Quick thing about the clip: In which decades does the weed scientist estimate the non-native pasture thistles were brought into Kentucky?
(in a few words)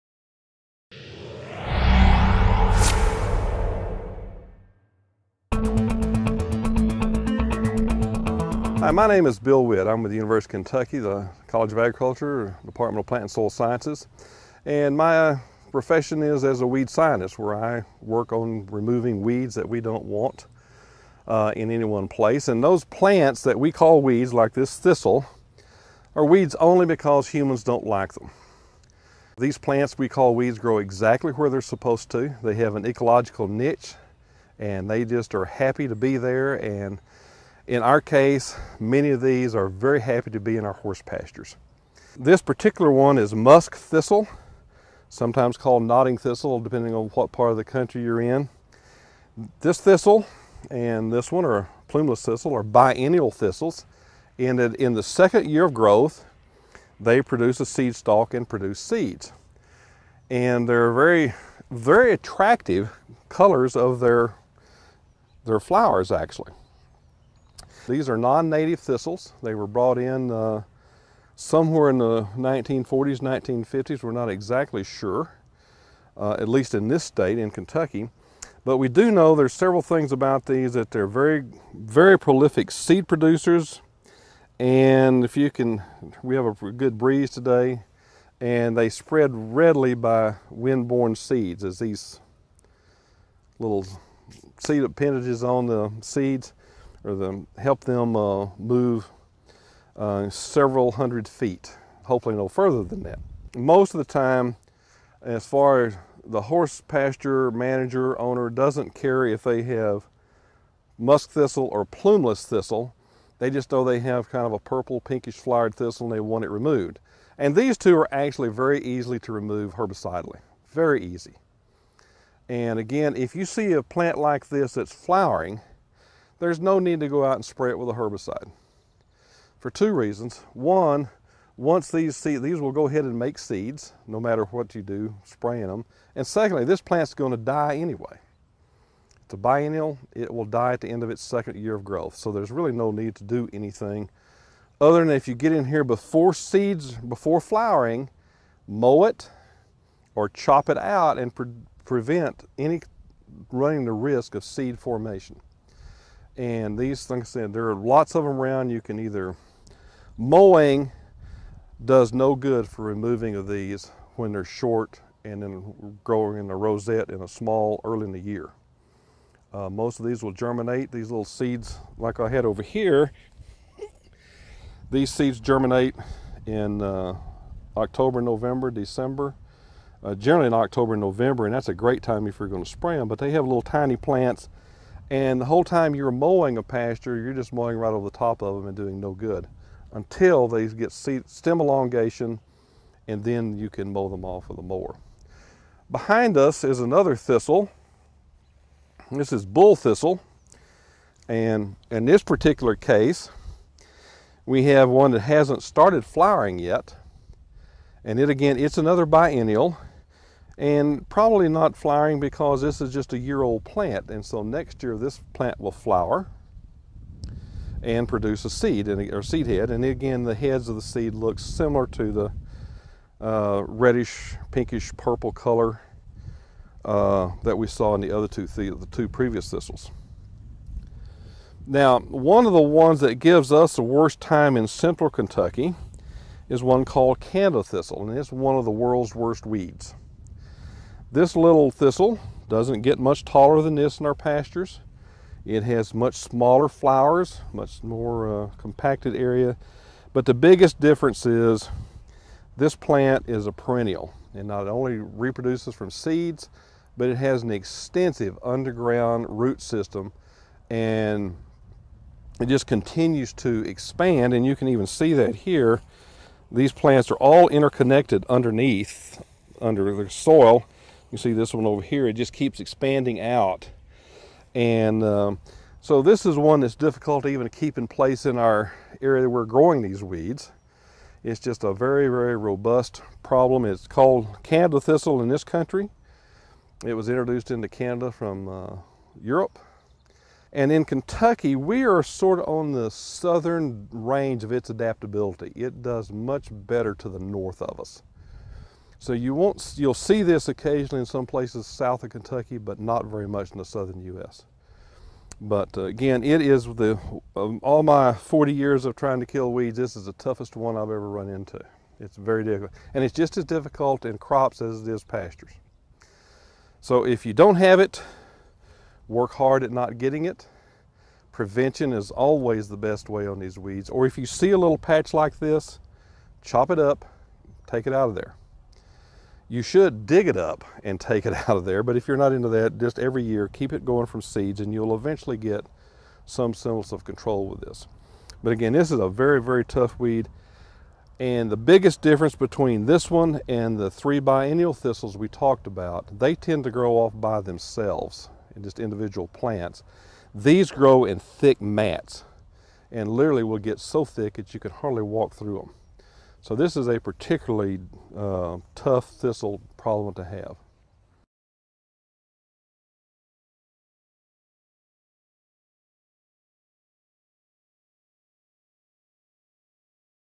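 1940s, 1950s.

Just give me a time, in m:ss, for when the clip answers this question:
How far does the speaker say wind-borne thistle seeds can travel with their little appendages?
1:40.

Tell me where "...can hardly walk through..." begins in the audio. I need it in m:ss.
5:54.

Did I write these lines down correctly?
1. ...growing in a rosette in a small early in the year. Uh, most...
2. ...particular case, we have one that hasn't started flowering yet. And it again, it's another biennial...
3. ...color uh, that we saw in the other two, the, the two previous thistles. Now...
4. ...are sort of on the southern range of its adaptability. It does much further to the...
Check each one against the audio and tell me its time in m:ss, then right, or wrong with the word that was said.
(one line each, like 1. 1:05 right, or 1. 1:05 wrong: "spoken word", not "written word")
1. 2:46 right
2. 3:22 right
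3. 3:45 right
4. 4:51 wrong: "better", not "further".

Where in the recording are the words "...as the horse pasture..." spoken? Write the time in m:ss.
1:45.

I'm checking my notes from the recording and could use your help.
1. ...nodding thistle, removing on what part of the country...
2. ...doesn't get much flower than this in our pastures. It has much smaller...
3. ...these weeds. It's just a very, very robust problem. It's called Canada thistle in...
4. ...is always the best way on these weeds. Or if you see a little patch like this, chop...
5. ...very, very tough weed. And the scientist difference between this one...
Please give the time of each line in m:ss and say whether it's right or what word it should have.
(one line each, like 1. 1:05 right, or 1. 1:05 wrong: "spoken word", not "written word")
1. 0:45 wrong: "depending", not "removing"
2. 4:02 wrong: "taller", not "flower"
3. 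4:39 right
4. 5:21 right
5. 5:39 wrong: "biggest", not "scientist".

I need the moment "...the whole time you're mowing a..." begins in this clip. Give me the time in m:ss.
3:05.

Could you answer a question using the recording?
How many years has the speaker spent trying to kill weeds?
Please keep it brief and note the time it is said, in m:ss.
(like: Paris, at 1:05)
40, at 5:08.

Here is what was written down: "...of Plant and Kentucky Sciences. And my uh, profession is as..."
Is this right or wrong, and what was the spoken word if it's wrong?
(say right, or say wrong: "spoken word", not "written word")
wrong: "Soil", not "Kentucky".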